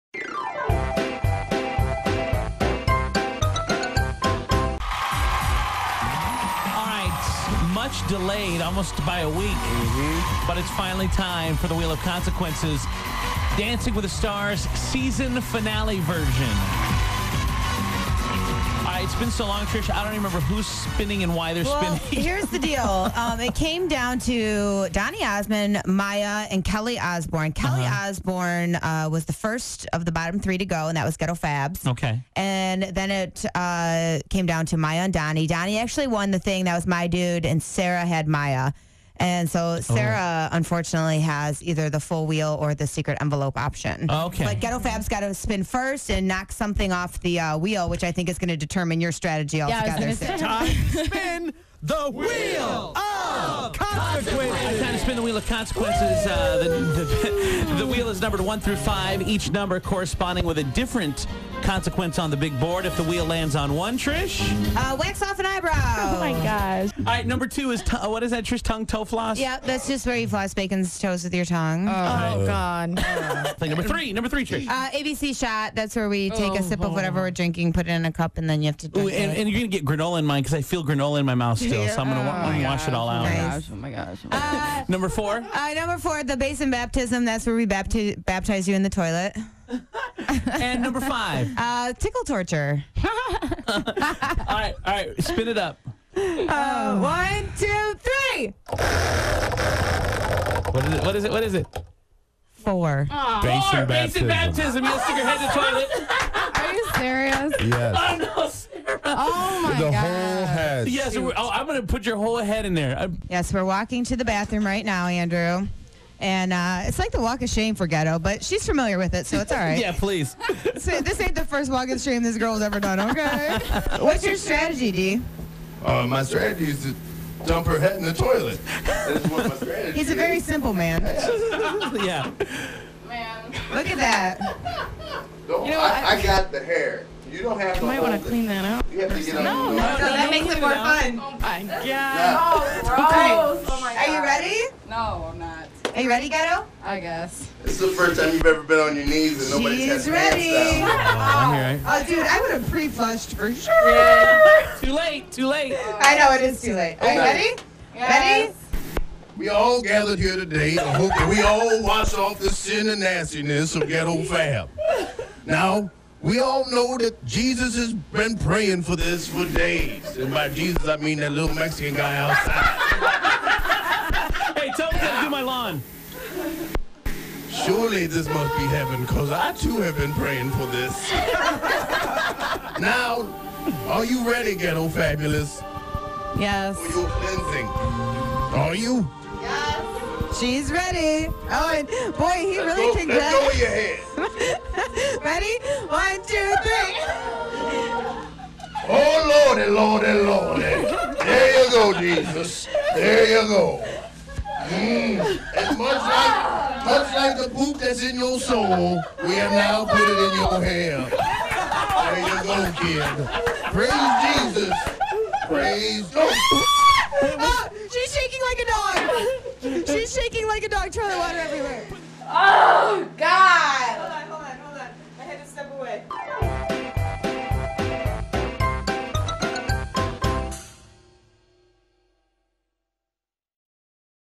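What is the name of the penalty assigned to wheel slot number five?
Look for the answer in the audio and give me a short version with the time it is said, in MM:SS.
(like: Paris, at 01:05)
Tickle torture, at 01:31.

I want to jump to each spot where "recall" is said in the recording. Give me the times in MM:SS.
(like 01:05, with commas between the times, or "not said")
not said.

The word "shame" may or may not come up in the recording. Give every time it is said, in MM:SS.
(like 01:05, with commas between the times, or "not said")
01:57, 02:01.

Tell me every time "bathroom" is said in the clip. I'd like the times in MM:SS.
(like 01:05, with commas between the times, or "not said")
01:54.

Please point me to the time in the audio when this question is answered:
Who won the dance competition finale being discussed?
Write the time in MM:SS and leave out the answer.
00:35.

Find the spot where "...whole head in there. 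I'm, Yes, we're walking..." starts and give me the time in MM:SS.
01:52.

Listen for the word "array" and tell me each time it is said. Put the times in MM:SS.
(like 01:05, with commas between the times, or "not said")
not said.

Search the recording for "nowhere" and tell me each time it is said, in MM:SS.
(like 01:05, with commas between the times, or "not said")
not said.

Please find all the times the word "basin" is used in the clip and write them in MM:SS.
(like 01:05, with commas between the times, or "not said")
01:26, 01:43.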